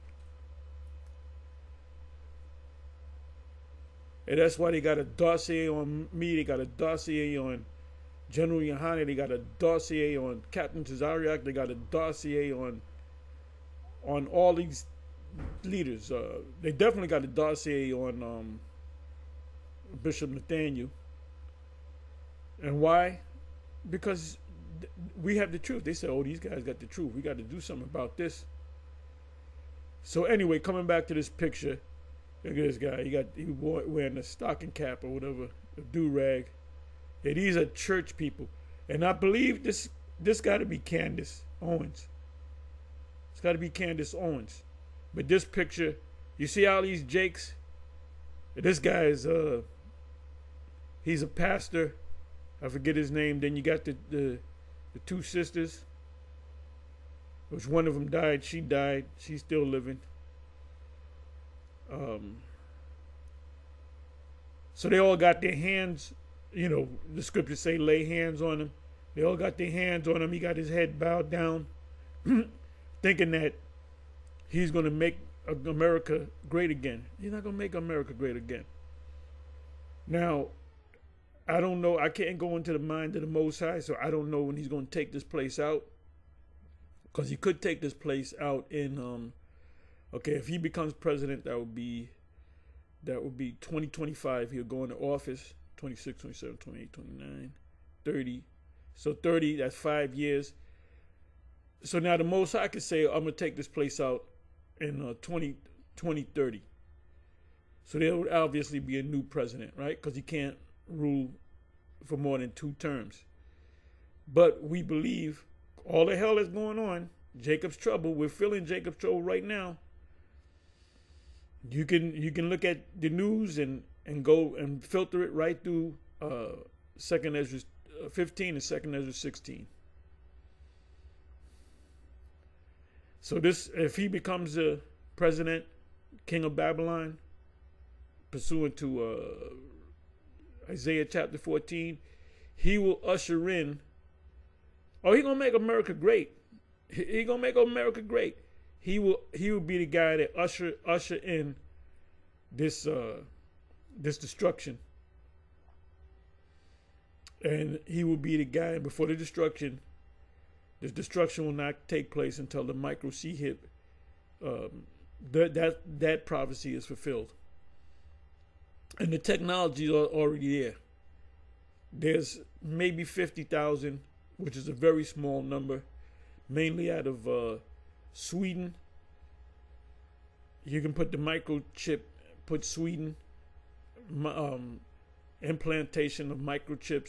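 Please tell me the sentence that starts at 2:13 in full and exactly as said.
So this, if he becomes the president, king of Babylon, pursuant to uh, Isaiah chapter 14, he will usher in.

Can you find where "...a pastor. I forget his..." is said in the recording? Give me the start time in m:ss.
0:51.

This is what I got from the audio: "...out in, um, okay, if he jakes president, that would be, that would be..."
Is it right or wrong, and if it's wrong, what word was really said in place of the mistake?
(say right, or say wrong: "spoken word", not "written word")
wrong: "becomes", not "jakes".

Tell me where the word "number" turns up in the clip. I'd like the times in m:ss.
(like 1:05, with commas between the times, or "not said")
2:55.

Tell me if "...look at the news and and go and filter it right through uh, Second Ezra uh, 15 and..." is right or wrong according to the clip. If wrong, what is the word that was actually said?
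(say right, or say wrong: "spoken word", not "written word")
right.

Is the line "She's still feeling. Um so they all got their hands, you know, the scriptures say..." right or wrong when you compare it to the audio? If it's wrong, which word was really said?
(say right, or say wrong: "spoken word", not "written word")
wrong: "living", not "feeling".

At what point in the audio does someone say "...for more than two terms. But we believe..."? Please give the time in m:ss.
1:52.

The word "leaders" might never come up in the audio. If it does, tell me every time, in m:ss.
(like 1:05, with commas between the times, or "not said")
0:15.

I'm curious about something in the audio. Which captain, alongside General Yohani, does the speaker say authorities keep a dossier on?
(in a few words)
Captain Tazariak.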